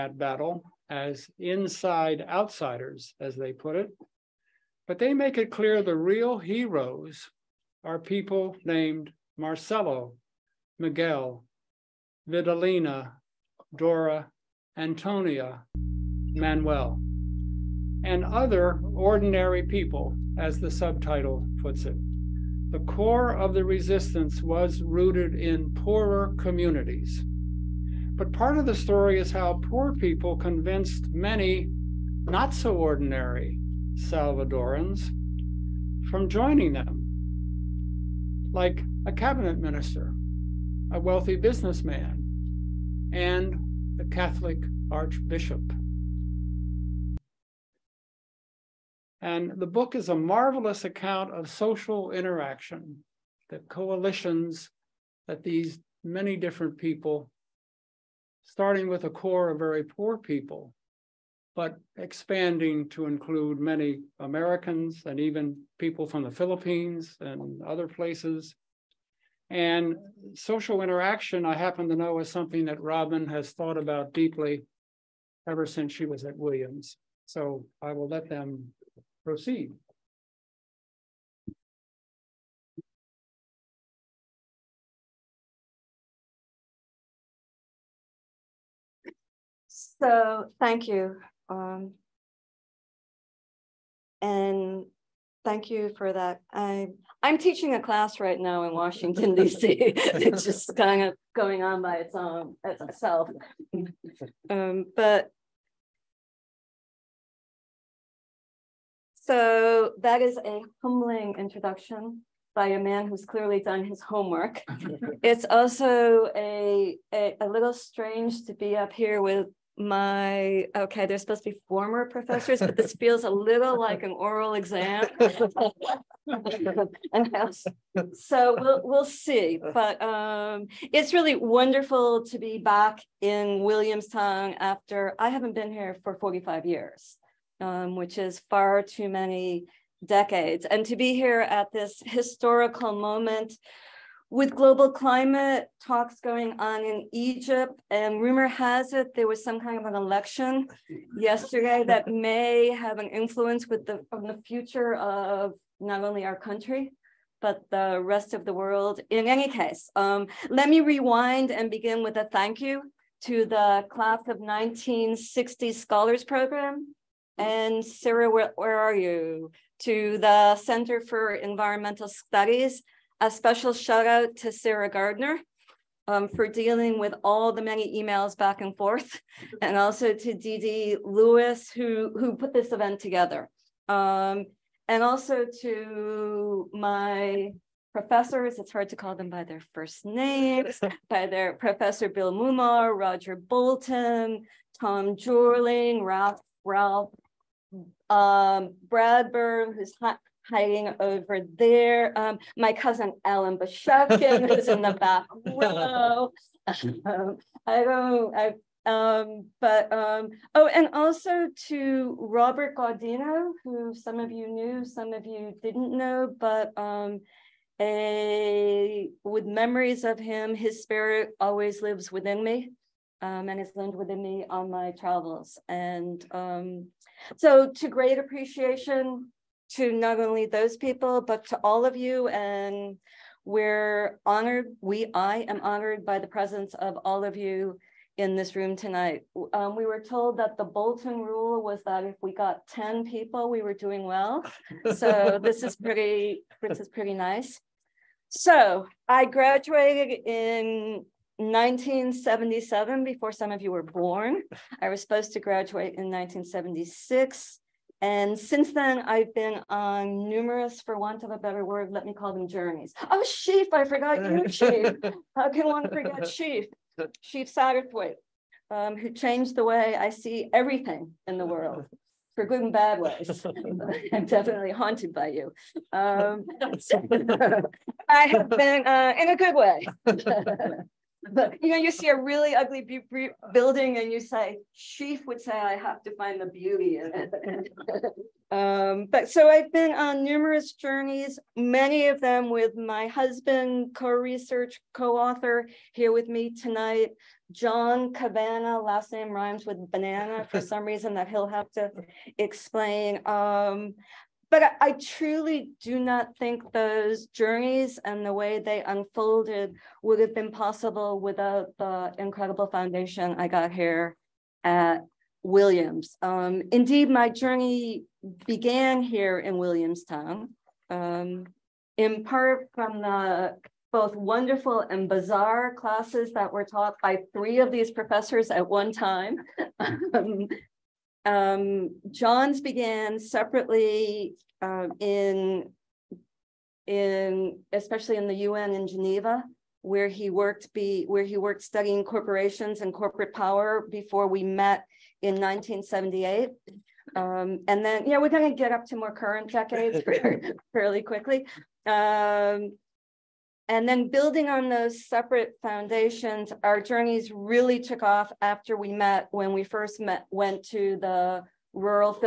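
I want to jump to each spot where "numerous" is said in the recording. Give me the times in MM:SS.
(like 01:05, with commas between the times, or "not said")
04:20, 04:50.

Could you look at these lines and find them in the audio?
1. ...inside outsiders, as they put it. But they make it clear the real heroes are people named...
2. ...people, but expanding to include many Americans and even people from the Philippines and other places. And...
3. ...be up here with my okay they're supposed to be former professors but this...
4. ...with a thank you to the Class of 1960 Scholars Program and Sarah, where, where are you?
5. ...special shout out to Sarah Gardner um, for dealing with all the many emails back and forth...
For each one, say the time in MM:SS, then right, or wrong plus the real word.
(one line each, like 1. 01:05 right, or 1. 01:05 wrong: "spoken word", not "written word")
1. 00:01 right
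2. 01:00 right
3. 01:58 right
4. 02:42 right
5. 02:53 right.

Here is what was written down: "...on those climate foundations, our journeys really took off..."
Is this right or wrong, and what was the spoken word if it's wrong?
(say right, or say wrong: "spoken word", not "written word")
wrong: "separate", not "climate".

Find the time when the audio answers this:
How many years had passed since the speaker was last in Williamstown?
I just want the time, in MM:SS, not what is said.
02:16.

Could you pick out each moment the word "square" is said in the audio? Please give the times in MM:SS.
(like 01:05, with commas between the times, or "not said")
not said.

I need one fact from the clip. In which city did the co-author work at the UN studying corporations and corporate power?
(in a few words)
Geneva.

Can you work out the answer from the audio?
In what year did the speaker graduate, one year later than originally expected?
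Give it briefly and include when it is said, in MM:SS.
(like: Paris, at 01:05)
1977, at 04:11.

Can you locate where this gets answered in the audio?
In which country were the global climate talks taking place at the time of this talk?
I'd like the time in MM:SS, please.
02:27.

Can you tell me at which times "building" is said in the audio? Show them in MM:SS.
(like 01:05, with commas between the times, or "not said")
04:43, 05:54.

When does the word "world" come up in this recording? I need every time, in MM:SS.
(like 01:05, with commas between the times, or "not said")
02:38, 04:31.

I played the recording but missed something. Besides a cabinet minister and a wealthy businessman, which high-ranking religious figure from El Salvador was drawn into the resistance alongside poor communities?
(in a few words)
the Catholic archbishop.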